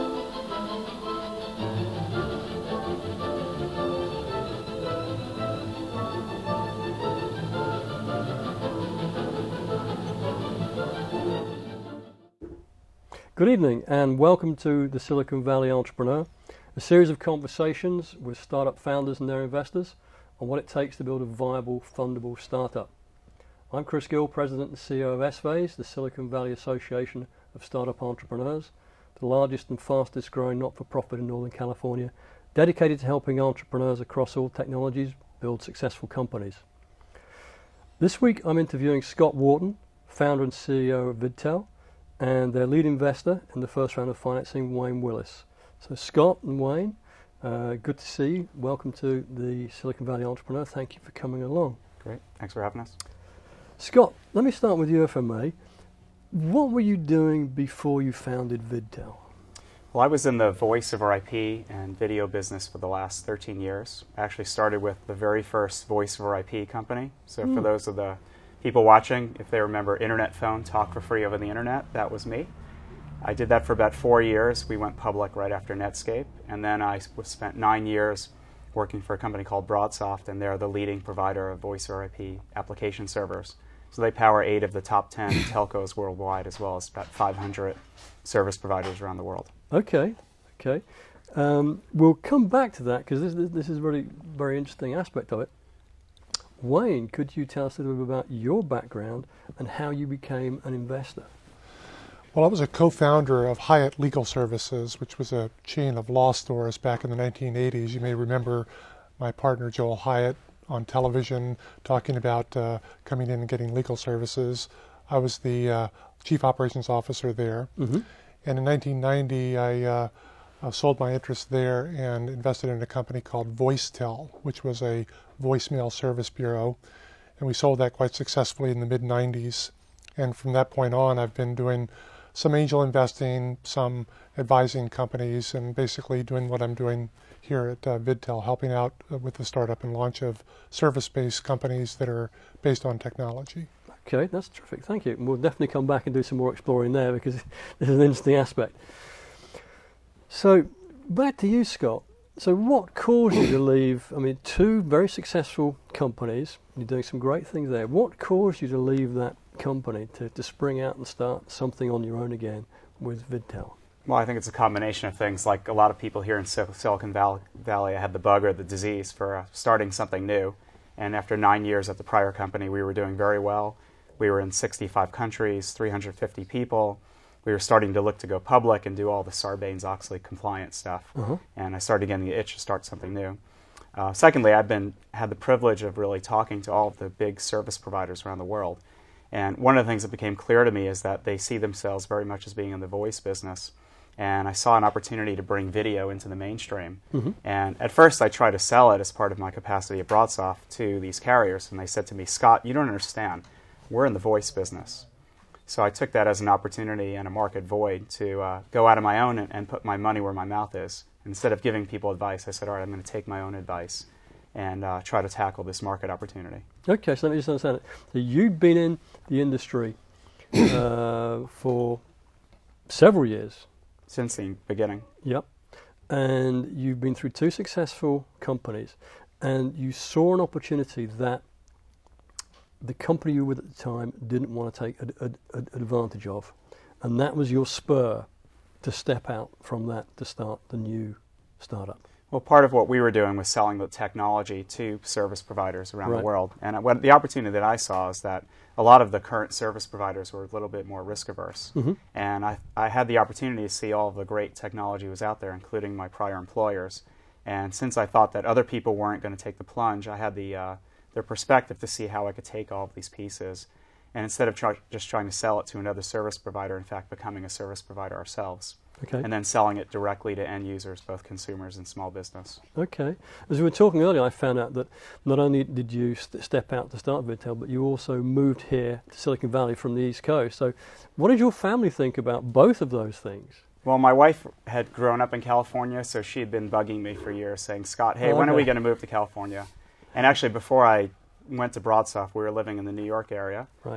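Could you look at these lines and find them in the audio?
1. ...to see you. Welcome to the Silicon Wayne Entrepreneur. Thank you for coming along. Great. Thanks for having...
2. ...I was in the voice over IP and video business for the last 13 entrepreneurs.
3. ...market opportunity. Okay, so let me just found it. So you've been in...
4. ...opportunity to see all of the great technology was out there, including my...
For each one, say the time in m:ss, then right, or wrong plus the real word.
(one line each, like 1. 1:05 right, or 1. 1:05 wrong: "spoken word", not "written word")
1. 0:47 wrong: "Valley", not "Wayne"
2. 1:00 wrong: "years", not "entrepreneurs"
3. 3:35 wrong: "understand", not "found"
4. 4:13 right.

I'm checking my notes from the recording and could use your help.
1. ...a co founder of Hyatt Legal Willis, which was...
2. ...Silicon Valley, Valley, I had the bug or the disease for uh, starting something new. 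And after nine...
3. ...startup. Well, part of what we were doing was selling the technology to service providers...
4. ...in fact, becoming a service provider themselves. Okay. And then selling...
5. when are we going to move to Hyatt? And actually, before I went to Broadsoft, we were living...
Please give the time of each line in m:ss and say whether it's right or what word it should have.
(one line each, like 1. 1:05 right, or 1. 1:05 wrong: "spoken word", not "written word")
1. 1:42 wrong: "Services", not "Willis"
2. 2:46 right
3. 4:01 right
4. 4:26 wrong: "ourselves", not "themselves"
5. 4:48 wrong: "California", not "Hyatt".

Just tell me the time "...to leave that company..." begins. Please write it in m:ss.
2:38.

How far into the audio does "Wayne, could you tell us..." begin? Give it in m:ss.
1:36.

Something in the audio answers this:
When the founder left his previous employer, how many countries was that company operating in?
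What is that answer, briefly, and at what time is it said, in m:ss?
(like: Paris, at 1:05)
65, at 2:54.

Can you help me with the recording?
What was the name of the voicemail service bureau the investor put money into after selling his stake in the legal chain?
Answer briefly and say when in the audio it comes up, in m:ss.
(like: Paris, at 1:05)
VoiceTel, at 2:03.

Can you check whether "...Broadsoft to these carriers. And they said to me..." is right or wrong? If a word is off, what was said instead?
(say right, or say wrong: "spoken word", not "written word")
right.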